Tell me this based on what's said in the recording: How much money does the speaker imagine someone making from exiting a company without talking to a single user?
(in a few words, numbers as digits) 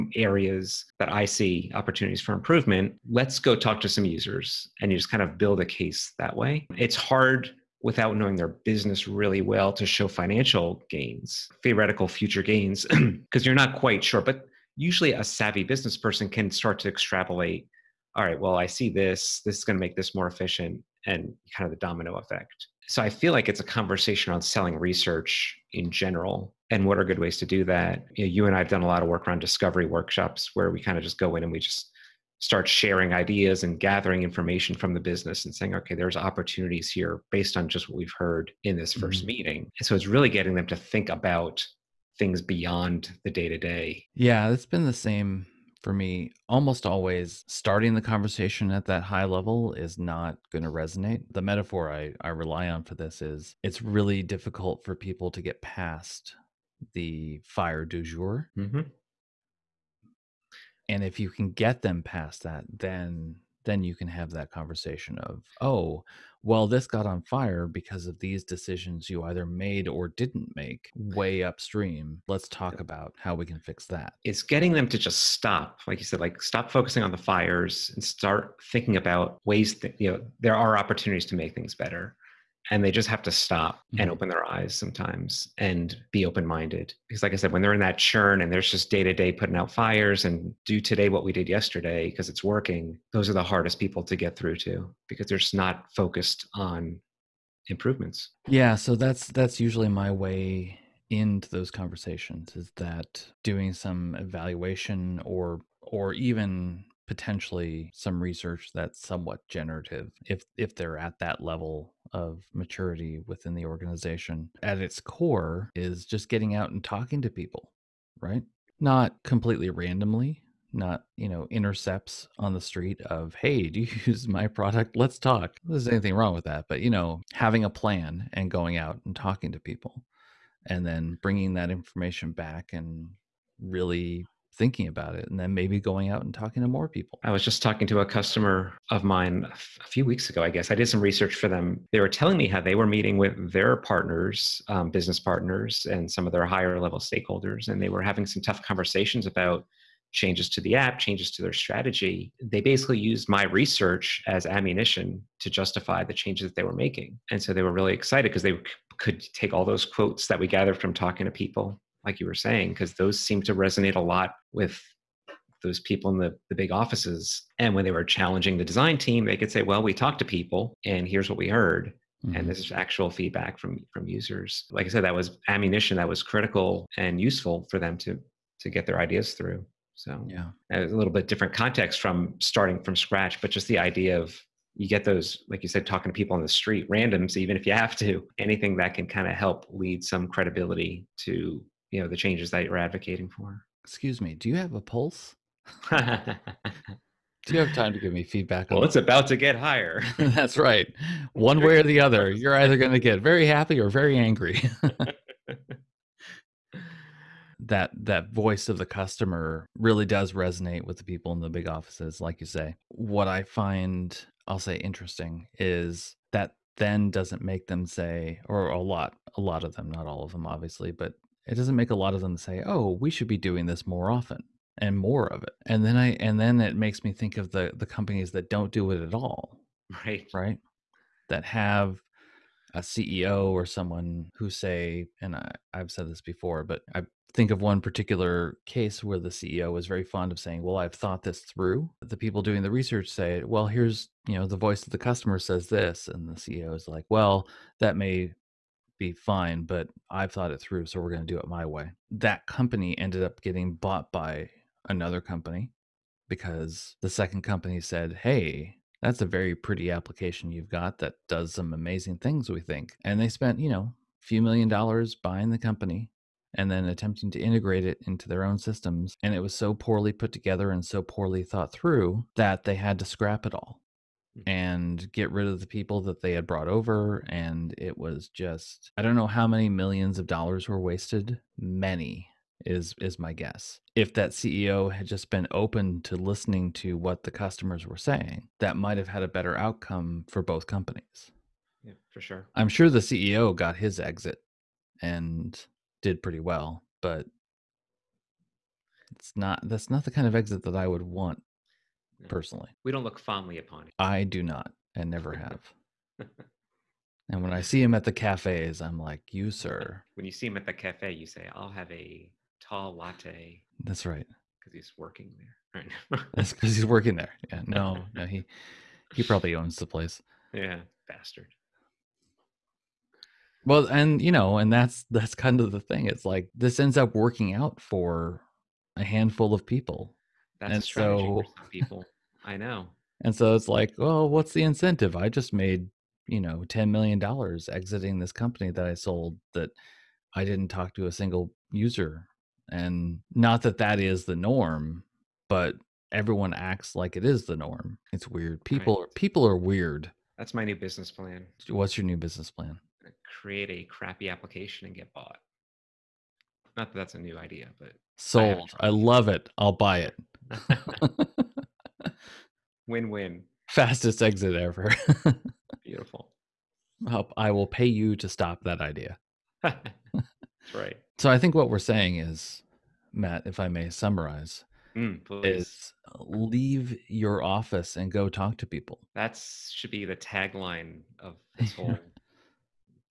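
$10 million.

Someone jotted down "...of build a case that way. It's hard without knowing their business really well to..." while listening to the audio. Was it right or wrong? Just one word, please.
right.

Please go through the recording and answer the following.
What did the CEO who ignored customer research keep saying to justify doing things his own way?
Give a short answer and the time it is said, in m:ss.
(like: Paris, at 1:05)
I've thought this through, at 4:00.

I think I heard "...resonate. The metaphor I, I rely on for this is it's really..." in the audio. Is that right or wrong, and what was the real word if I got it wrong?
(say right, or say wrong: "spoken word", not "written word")
right.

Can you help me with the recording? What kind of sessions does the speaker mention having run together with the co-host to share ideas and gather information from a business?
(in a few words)
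discovery workshops.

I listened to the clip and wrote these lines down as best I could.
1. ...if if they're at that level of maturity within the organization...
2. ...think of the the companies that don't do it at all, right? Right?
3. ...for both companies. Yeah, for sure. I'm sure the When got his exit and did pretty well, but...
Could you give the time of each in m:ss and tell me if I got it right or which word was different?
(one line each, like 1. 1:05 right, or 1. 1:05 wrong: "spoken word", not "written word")
1. 1:50 right
2. 3:47 right
3. 4:50 wrong: "CEO", not "When".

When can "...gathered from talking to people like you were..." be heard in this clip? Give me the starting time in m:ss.
2:40.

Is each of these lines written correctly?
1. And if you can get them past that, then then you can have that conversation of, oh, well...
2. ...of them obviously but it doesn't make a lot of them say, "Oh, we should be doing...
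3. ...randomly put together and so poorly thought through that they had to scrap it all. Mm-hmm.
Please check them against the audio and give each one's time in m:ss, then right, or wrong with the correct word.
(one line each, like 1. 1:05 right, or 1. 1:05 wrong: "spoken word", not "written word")
1. 1:00 right
2. 3:40 right
3. 4:29 wrong: "poorly", not "randomly".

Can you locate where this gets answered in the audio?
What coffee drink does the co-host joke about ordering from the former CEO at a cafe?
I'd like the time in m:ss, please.
5:12.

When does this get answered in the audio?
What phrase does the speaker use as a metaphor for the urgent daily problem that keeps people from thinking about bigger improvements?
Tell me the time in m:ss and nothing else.
0:57.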